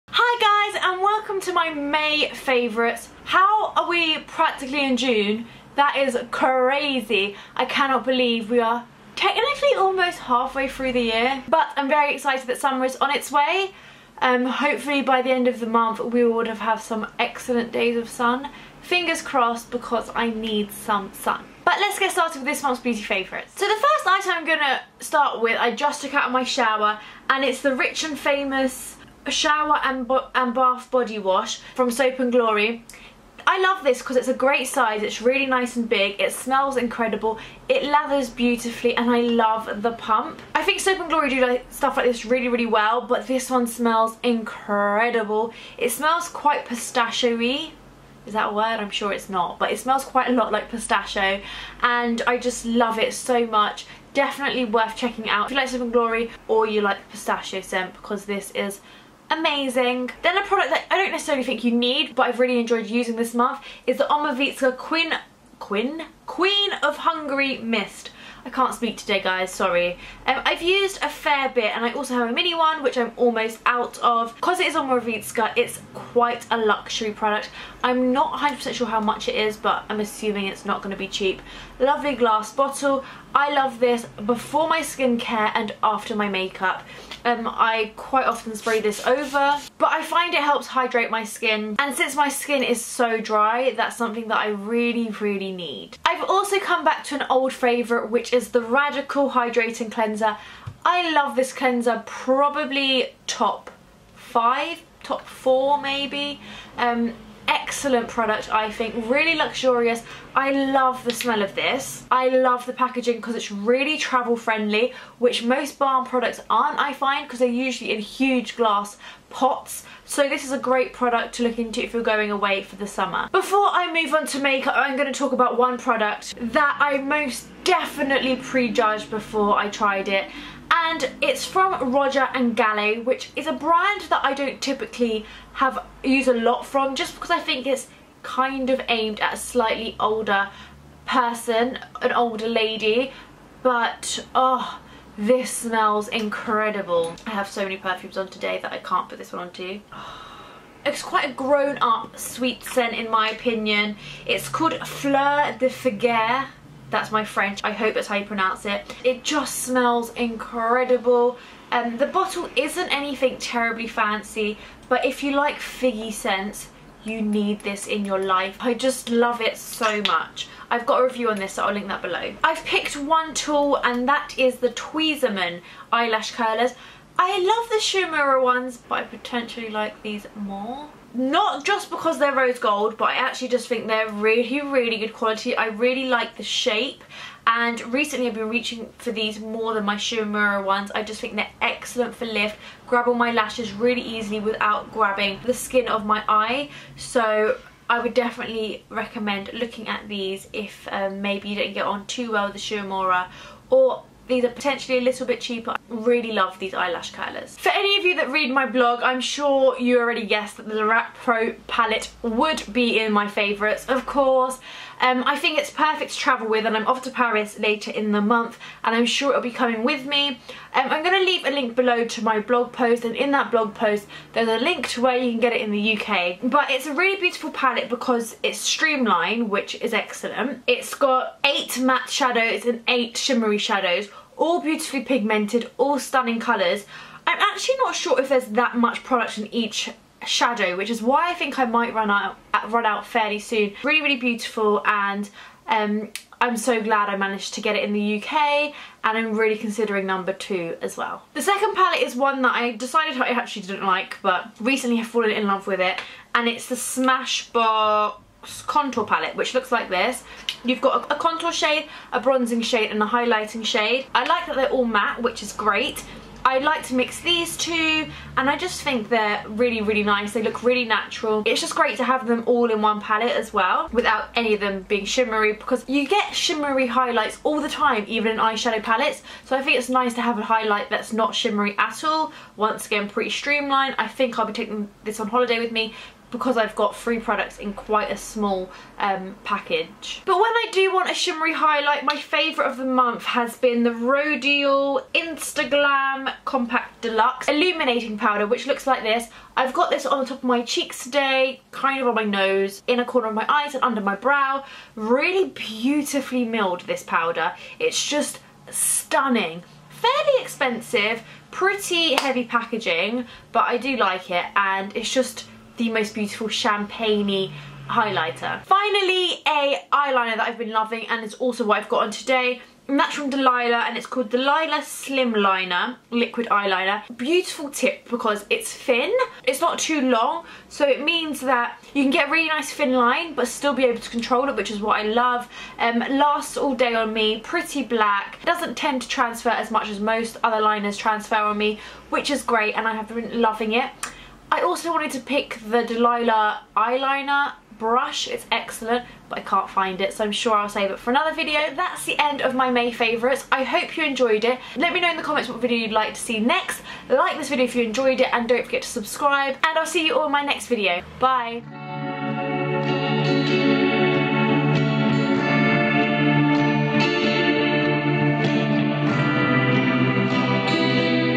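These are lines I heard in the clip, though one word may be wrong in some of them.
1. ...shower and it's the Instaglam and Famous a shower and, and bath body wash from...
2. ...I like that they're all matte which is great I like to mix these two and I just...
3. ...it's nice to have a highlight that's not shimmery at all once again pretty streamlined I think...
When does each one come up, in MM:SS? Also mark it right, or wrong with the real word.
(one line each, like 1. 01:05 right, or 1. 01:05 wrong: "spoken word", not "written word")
1. 00:26 wrong: "Rich", not "Instaglam"
2. 04:24 right
3. 04:39 right.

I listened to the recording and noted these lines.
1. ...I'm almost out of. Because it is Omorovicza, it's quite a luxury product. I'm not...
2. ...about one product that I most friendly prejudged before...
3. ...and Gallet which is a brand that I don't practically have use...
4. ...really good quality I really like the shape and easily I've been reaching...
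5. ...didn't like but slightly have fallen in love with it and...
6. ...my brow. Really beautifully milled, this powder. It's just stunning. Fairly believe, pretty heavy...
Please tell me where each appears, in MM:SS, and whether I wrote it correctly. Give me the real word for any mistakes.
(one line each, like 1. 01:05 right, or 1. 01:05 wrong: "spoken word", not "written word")
1. 01:12 right
2. 02:05 wrong: "definitely", not "friendly"
3. 02:12 wrong: "typically", not "practically"
4. 03:04 wrong: "recently", not "easily"
5. 04:13 wrong: "recently", not "slightly"
6. 05:04 wrong: "expensive", not "believe".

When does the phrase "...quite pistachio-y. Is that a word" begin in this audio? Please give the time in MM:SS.
00:46.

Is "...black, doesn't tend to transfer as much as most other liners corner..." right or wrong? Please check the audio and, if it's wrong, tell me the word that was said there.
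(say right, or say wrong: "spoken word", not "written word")
wrong: "transfer", not "corner".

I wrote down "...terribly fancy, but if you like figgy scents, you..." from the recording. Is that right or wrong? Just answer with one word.
right.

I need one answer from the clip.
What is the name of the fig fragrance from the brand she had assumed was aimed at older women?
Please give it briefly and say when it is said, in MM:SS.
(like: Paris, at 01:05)
Fleur de Figuier, at 02:34.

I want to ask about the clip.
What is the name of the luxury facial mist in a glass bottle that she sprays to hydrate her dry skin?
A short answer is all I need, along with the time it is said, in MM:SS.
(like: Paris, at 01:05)
Queen of Hungary Mist, at 01:06.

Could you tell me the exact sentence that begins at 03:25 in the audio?
I really love these eyelash curlers.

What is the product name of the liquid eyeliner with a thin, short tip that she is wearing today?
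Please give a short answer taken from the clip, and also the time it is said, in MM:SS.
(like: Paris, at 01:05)
Delilah Slim Liner, at 05:24.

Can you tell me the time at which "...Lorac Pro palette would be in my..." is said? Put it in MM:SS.
03:30.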